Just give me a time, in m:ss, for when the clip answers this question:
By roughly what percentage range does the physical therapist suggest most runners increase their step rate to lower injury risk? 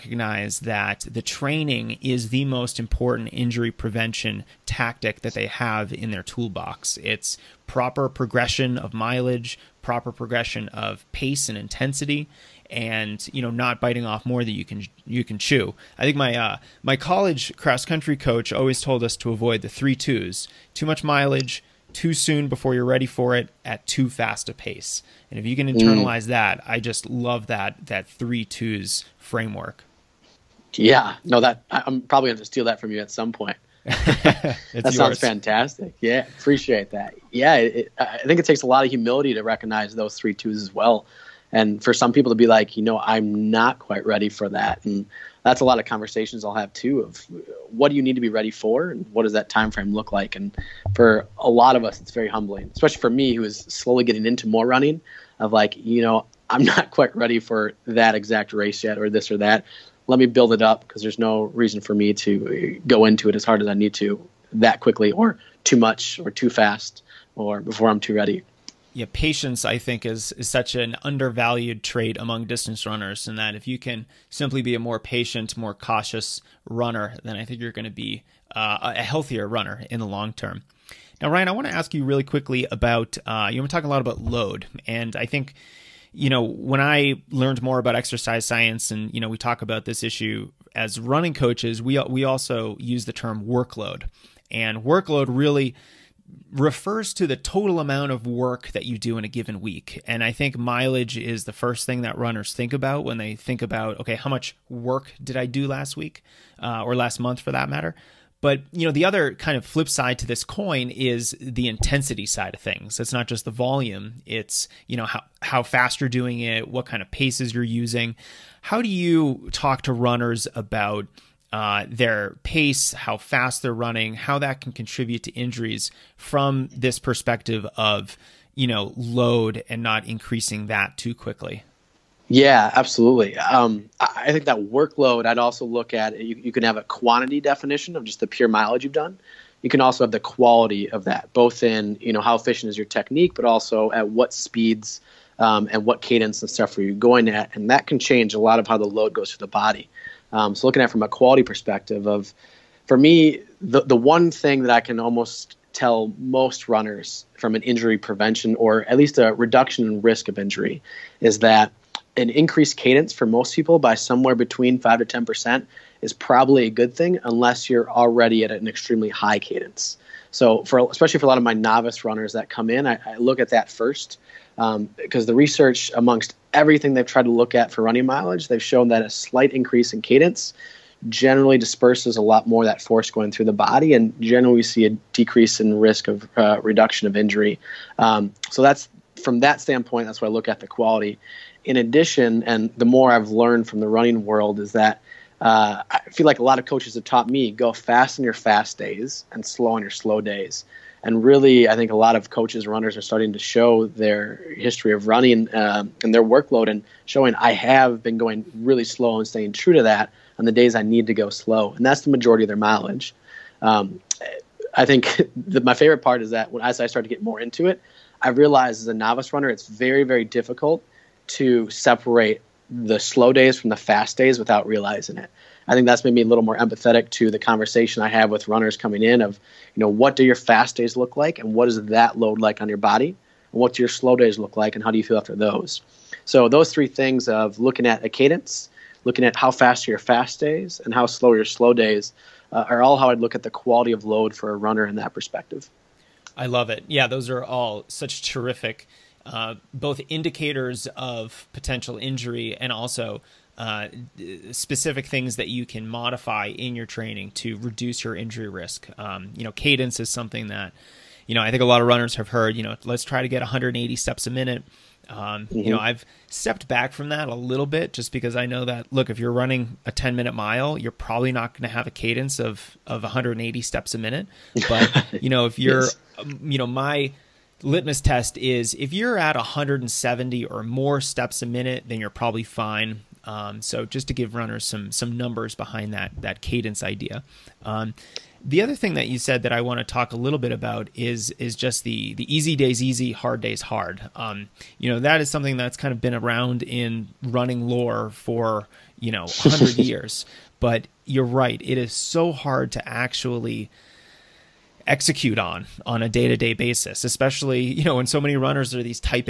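2:44.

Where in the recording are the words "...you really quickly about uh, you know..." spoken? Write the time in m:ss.
1:21.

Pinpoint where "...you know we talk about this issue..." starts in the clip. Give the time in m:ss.
1:29.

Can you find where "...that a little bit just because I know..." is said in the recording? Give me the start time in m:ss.
4:27.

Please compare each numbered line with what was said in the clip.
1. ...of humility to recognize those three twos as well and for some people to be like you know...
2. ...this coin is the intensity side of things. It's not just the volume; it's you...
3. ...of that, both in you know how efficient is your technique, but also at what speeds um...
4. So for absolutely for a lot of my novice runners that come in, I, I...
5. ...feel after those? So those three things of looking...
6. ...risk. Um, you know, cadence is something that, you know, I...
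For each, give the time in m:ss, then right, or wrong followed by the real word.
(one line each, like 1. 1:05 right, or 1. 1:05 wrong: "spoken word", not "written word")
1. 0:38 right
2. 1:50 right
3. 2:20 right
4. 2:50 wrong: "especially", not "absolutely"
5. 3:55 right
6. 4:18 right.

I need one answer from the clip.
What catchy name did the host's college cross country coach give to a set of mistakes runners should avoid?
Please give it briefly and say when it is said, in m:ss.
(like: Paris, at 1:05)
the three twos, at 0:19.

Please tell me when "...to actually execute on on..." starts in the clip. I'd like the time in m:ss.
5:02.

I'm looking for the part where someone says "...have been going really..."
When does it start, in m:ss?
3:27.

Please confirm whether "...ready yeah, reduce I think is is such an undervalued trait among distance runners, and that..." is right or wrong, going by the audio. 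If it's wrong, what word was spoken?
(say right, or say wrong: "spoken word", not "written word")
wrong: "patience", not "reduce".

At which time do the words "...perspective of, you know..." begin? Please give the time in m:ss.
2:06.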